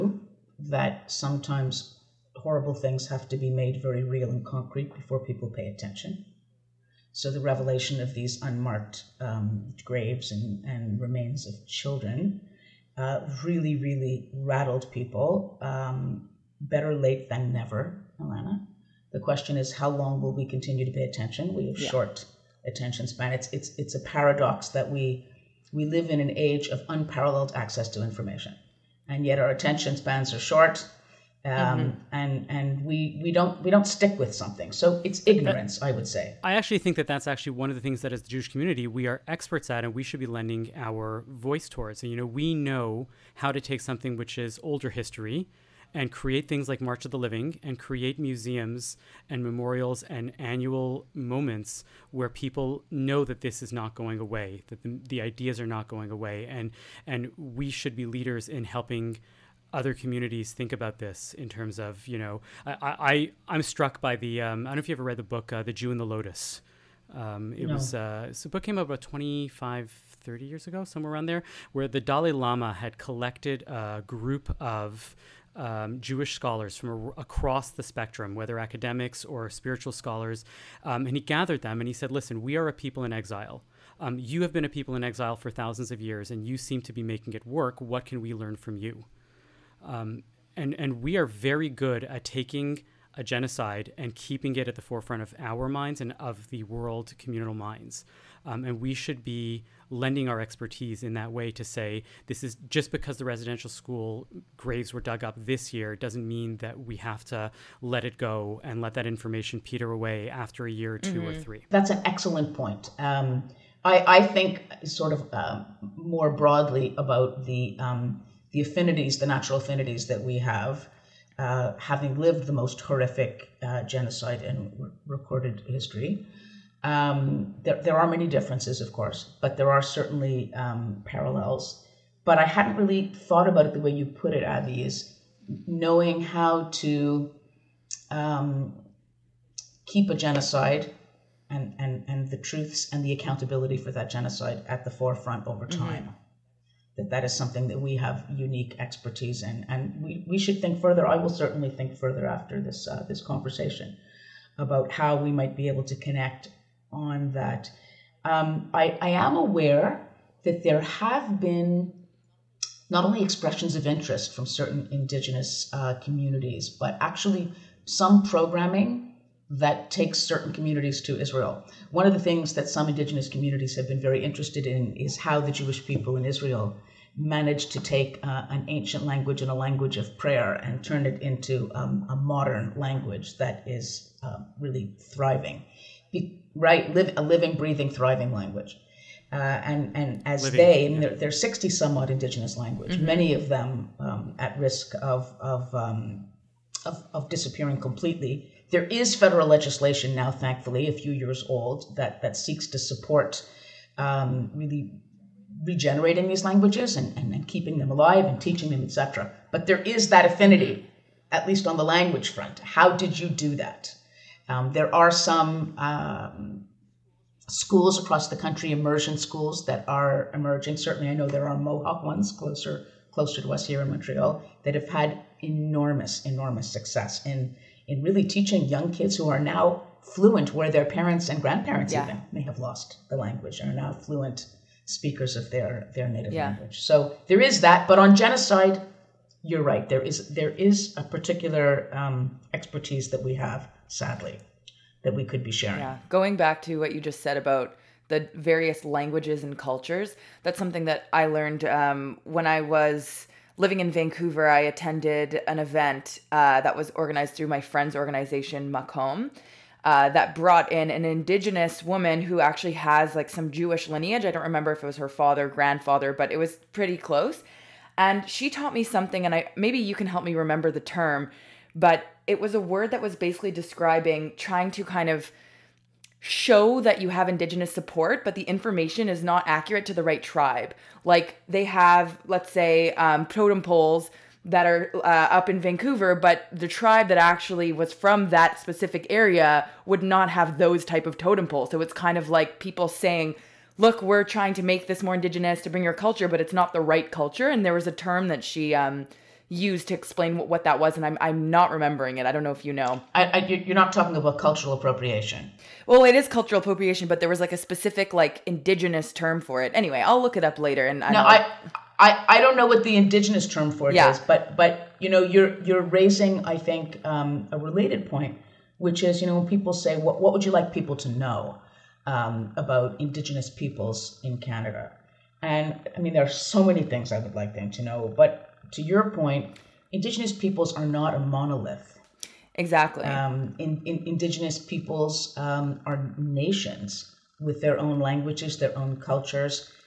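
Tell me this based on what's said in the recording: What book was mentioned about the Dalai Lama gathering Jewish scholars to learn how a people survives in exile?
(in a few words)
The Jew and the Lotus.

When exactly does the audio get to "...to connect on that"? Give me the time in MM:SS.
02:35.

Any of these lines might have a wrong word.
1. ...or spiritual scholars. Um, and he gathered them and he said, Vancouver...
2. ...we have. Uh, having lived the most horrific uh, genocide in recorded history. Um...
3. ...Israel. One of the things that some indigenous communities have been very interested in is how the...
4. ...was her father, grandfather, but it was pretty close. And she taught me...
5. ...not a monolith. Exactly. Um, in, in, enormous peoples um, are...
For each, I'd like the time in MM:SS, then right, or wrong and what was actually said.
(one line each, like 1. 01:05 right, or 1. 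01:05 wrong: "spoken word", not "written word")
1. 01:19 wrong: "Listen", not "Vancouver"
2. 02:00 right
3. 02:51 right
4. 04:24 right
5. 05:30 wrong: "indigenous", not "enormous".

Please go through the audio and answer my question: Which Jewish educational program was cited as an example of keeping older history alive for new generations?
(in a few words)
March of the Living.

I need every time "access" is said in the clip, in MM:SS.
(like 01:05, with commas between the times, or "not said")
00:27.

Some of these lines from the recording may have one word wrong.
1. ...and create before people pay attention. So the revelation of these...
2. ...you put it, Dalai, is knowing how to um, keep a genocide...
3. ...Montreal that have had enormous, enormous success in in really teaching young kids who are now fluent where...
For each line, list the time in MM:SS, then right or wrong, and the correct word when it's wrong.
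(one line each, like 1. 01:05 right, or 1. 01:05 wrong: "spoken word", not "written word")
1. 00:04 wrong: "concrete", not "create"
2. 02:13 wrong: "Avi", not "Dalai"
3. 03:43 right.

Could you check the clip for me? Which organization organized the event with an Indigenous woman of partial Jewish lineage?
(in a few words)
Macomb.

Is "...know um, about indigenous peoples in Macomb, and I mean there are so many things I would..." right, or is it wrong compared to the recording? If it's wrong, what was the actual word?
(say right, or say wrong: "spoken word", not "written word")
wrong: "Canada", not "Macomb".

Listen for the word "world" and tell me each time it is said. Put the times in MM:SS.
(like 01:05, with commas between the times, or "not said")
01:36.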